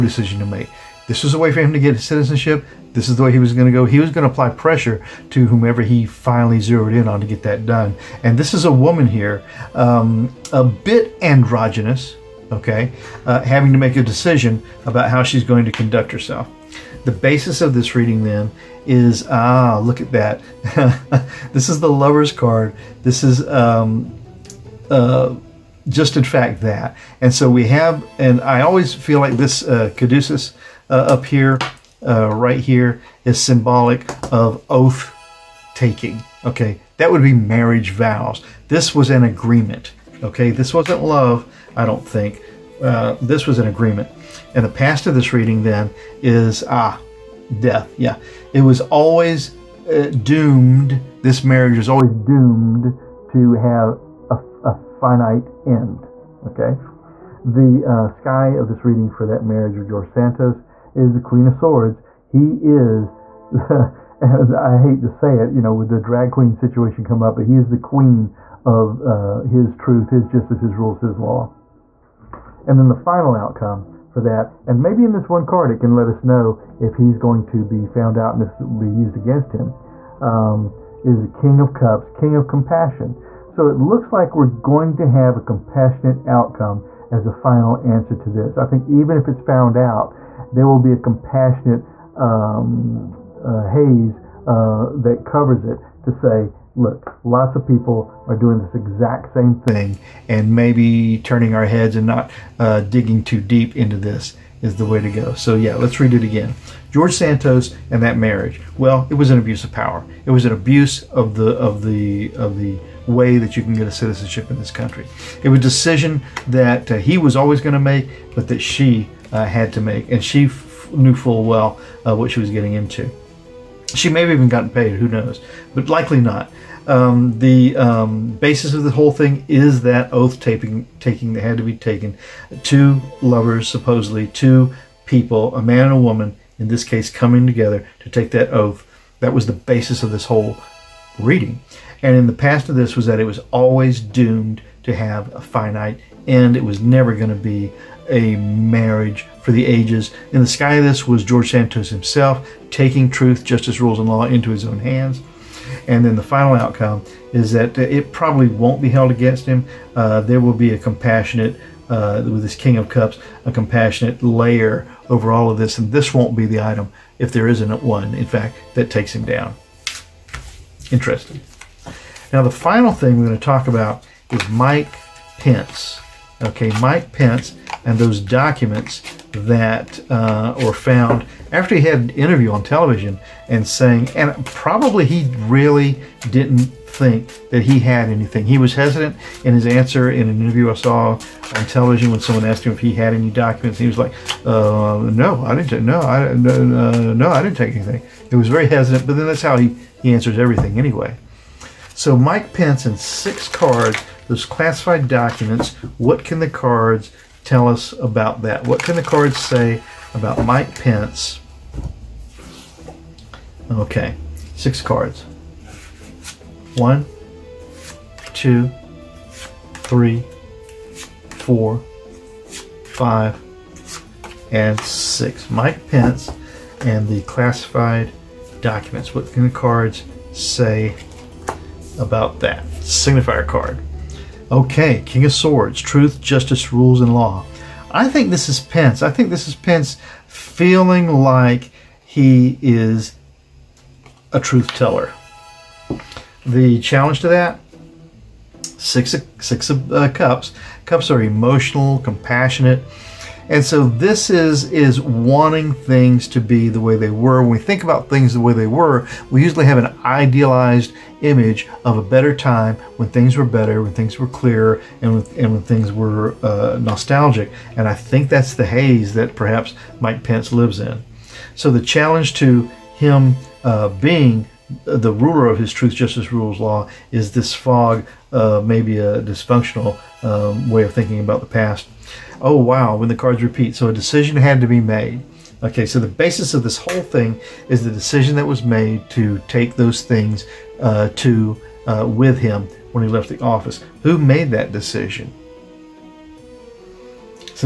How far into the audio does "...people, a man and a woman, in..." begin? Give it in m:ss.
2:15.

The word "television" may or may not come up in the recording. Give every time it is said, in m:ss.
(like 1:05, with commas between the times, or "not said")
3:02, 3:11.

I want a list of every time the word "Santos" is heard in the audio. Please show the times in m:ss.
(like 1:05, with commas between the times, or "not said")
1:00, 1:47, 2:31.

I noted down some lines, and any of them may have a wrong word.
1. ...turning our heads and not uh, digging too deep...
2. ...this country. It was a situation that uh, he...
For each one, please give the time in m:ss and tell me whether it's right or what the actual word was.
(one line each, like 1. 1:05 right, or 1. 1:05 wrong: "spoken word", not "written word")
1. 1:41 right
2. 1:54 wrong: "decision", not "situation".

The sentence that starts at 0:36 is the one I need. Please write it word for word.
Okay, that would be marriage vows.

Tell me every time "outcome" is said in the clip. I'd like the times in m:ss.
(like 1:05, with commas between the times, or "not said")
1:13, 1:26, 2:36.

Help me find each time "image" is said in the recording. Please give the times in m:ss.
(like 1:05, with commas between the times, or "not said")
4:21.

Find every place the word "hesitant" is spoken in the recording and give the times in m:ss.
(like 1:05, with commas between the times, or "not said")
3:08, 3:18.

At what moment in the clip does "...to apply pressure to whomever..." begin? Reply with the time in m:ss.
0:04.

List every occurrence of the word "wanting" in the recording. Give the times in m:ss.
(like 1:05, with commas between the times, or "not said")
4:14.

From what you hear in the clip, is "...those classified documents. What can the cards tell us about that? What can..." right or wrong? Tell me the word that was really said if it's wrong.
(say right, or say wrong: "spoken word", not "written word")
right.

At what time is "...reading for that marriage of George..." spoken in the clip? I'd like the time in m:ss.
0:58.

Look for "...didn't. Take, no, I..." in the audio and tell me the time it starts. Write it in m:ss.
3:15.